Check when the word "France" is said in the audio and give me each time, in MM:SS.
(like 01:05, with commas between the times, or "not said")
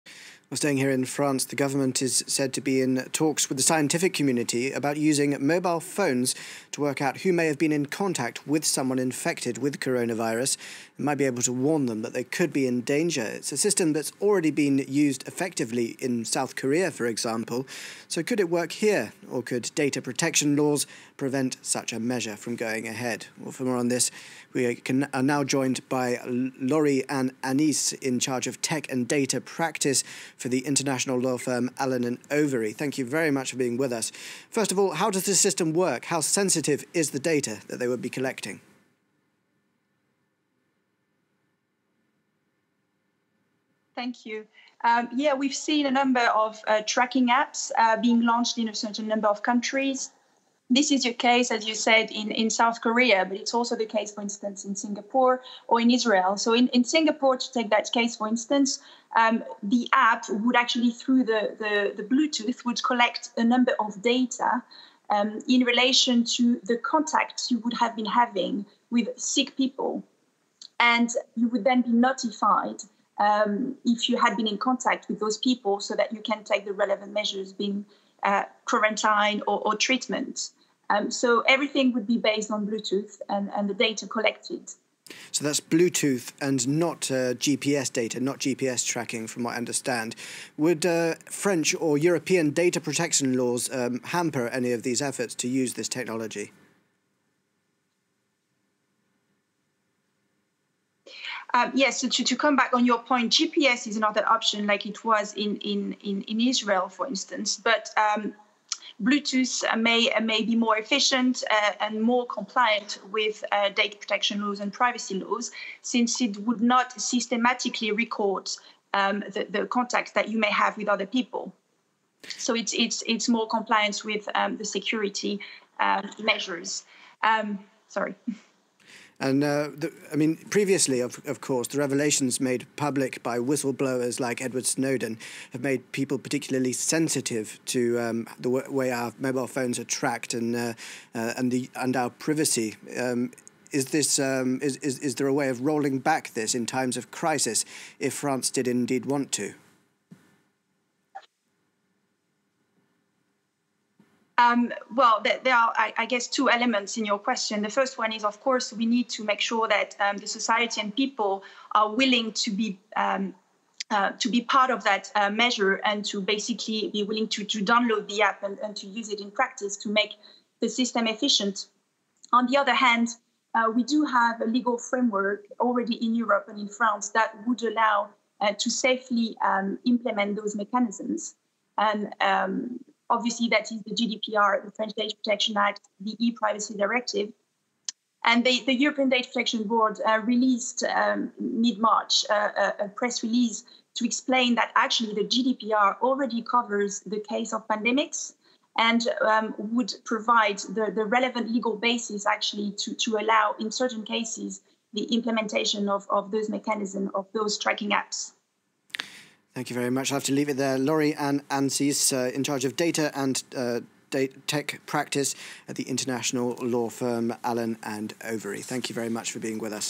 00:01, 02:28, 02:56.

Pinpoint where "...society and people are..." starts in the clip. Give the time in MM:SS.
02:40.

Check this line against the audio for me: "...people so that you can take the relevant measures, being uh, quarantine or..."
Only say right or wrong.
right.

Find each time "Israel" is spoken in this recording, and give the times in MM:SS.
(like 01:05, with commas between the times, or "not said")
00:55, 01:46.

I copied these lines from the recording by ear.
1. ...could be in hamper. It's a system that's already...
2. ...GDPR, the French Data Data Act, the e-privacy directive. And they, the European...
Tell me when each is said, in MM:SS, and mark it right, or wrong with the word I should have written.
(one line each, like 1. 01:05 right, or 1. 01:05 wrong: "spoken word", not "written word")
1. 00:12 wrong: "danger", not "hamper"
2. 03:03 wrong: "Protection", not "Data".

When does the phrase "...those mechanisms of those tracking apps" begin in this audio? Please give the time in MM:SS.
03:26.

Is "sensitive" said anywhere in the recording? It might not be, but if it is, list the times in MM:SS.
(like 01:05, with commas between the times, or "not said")
00:36, 02:16.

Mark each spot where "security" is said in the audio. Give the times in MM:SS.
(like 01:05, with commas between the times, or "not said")
02:04.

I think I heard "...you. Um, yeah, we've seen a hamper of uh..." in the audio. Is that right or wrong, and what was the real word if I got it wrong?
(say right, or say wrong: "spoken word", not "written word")
wrong: "number", not "hamper".